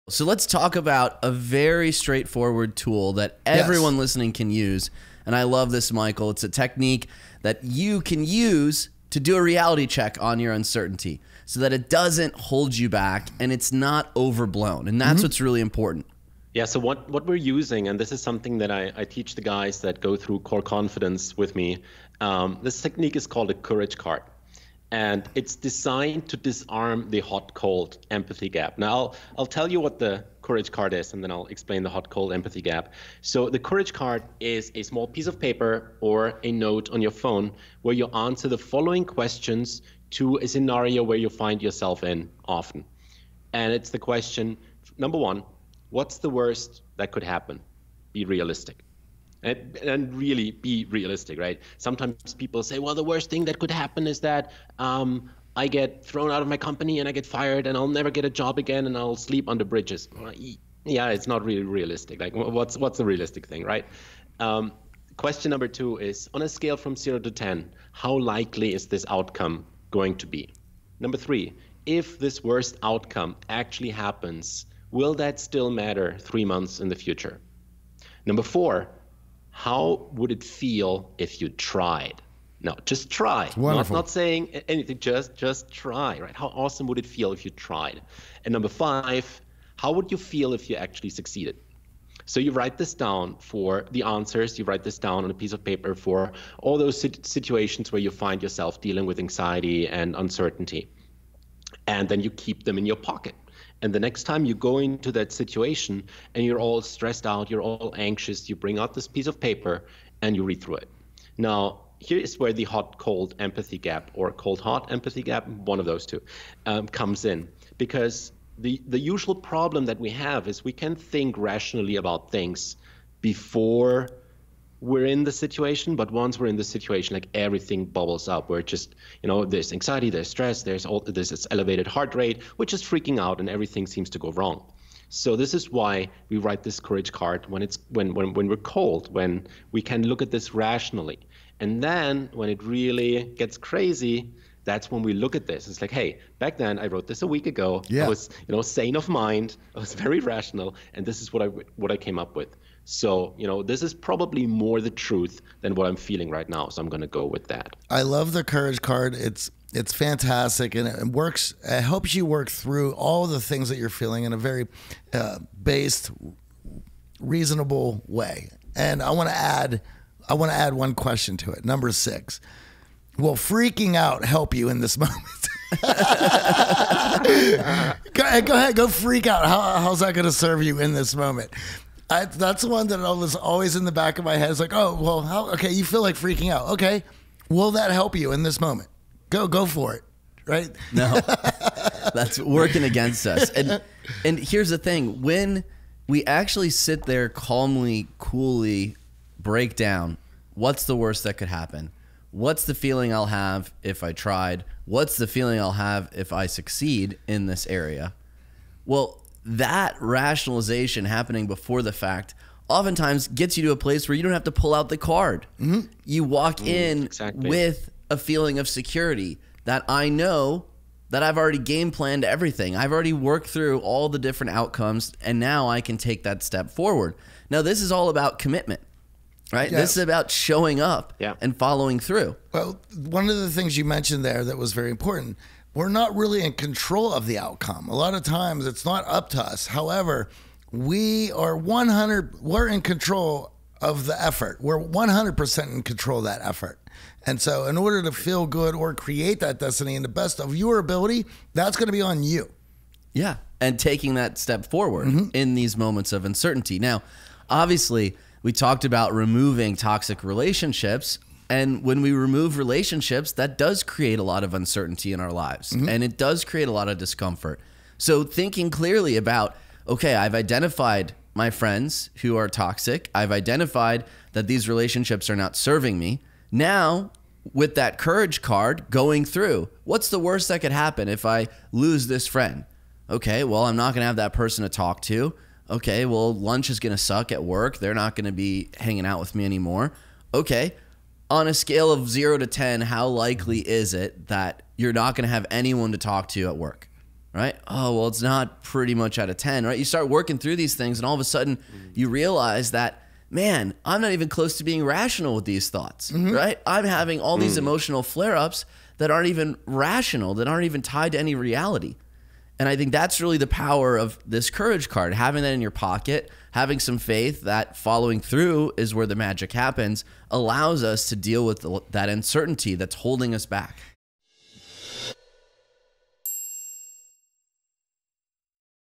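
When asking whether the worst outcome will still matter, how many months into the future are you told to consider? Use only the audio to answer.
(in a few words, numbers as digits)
3.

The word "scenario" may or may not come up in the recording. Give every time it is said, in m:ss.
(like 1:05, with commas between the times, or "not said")
0:40.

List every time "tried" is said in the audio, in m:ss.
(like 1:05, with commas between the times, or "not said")
1:21, 1:27, 3:24.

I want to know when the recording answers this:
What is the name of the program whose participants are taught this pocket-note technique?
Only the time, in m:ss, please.
0:20.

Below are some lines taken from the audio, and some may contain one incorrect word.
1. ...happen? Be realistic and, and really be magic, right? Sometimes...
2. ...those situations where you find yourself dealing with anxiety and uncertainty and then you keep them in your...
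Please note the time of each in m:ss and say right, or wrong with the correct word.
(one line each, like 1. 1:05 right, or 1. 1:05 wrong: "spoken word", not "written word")
1. 0:47 wrong: "realistic", not "magic"
2. 1:36 right.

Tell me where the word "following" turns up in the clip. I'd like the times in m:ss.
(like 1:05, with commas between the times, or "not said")
0:38, 3:51, 5:17.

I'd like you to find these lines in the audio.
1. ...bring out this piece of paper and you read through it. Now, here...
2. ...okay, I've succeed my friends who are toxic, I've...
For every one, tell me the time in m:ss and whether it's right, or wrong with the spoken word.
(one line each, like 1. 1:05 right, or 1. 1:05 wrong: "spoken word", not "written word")
1. 1:48 right
2. 4:29 wrong: "identified", not "succeed".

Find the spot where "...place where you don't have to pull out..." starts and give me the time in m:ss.
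3:33.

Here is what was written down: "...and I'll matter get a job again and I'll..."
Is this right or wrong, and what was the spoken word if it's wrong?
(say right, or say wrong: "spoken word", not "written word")
wrong: "never", not "matter".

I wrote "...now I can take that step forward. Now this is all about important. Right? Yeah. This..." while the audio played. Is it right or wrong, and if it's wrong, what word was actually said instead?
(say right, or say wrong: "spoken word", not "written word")
wrong: "commitment", not "important".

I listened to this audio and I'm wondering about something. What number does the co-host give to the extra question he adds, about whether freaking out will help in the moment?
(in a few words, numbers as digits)
6.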